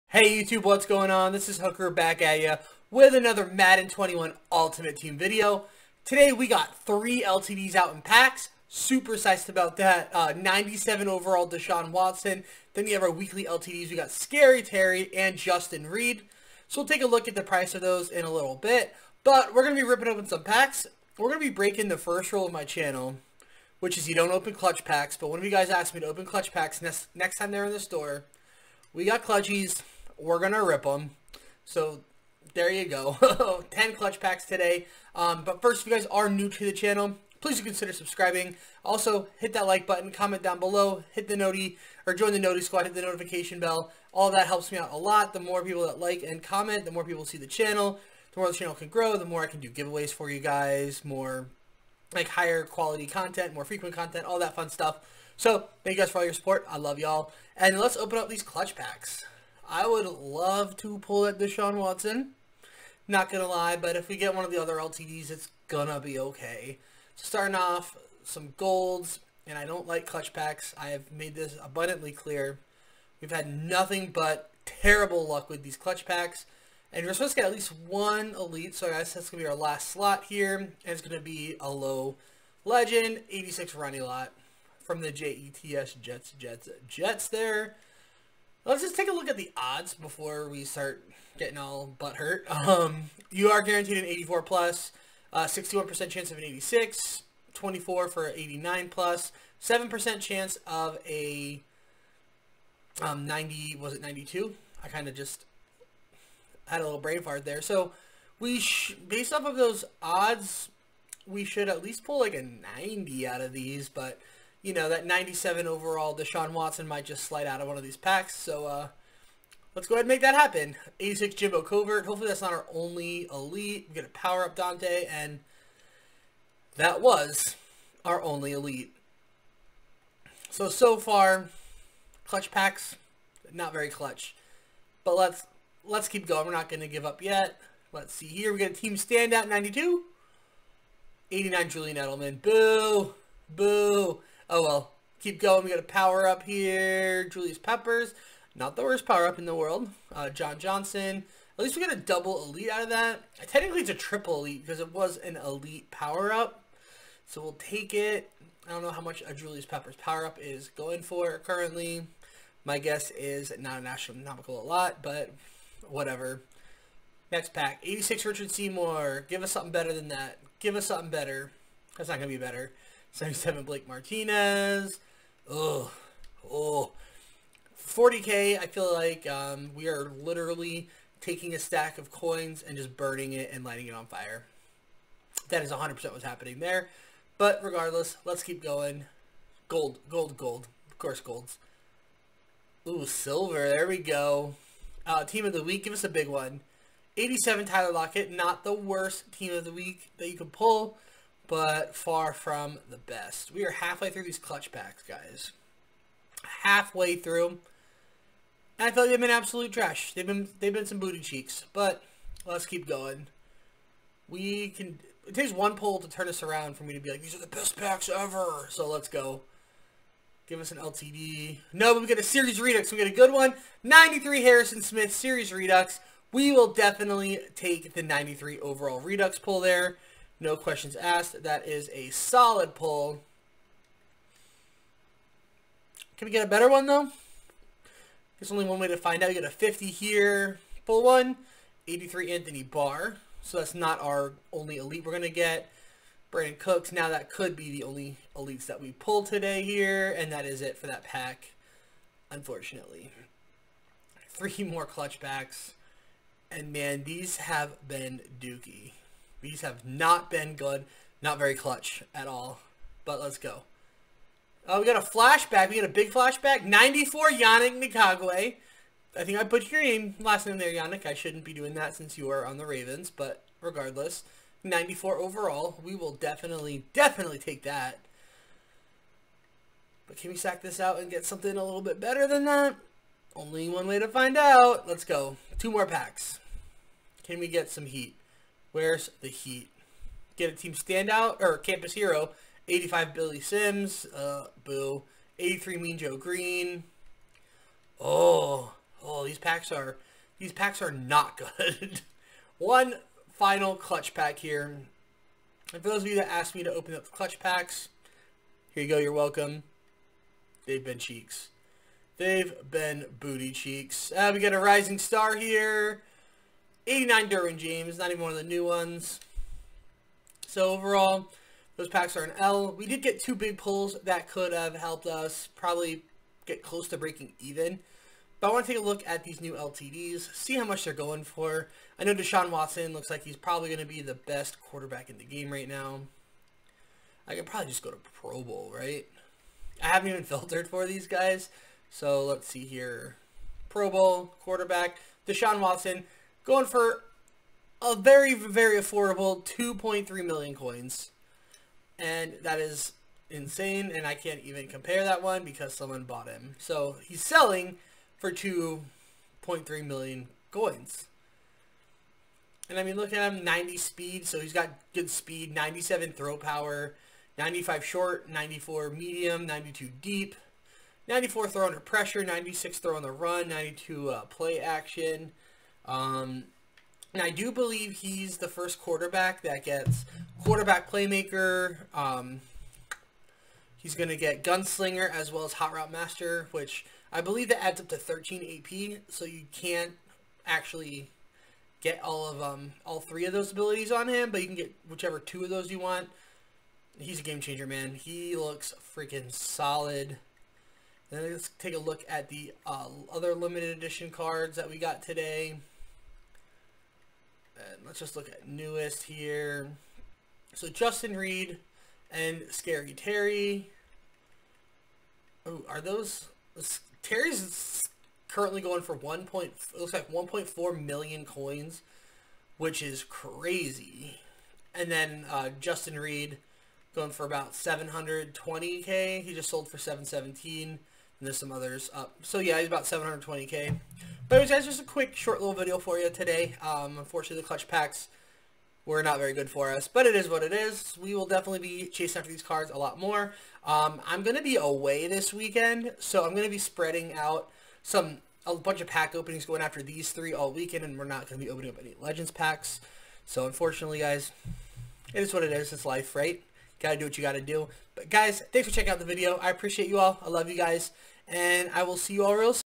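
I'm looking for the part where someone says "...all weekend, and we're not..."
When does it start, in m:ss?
7:30.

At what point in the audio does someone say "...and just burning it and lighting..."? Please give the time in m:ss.
3:02.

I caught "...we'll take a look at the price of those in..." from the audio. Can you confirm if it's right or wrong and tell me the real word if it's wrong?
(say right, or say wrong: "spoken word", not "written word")
right.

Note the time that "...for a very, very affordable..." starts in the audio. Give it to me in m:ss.
5:46.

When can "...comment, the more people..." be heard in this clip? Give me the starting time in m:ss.
0:46.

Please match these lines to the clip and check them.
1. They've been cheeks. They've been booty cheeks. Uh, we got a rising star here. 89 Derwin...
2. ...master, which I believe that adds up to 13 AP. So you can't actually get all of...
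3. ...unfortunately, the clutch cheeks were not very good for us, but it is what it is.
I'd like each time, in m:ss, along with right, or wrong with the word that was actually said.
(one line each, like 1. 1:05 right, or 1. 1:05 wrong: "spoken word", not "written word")
1. 5:10 right
2. 6:25 right
3. 7:16 wrong: "packs", not "cheeks".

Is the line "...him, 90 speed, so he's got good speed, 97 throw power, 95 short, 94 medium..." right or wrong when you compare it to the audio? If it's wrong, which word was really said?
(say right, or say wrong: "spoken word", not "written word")
right.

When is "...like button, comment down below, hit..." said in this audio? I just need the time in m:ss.
0:39.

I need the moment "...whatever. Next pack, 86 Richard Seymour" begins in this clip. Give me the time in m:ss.
2:45.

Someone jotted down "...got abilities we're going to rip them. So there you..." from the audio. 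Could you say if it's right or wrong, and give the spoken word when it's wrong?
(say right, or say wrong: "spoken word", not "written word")
wrong: "clutchies", not "abilities".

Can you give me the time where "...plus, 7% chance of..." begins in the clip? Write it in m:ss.
1:38.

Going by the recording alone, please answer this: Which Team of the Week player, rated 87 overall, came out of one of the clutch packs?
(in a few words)
Tyler Lockett.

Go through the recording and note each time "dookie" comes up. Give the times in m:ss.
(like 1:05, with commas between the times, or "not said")
4:18.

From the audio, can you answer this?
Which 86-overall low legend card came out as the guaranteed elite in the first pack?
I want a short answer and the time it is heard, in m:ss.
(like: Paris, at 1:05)
Ronnie Lott, at 1:23.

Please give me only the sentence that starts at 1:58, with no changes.
So uh, let's go ahead and make that happen.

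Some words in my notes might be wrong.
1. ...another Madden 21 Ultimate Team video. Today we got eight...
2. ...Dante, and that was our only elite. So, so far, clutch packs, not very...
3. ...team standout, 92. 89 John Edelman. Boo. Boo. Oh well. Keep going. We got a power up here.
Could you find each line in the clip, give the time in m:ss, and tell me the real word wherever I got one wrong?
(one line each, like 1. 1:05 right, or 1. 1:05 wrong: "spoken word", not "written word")
1. 0:03 wrong: "three", not "eight"
2. 2:04 right
3. 2:18 wrong: "Julian", not "John".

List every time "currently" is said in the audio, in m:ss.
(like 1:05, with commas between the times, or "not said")
2:41, 6:58.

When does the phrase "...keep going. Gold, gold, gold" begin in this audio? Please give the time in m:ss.
3:08.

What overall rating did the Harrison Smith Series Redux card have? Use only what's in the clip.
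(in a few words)
93.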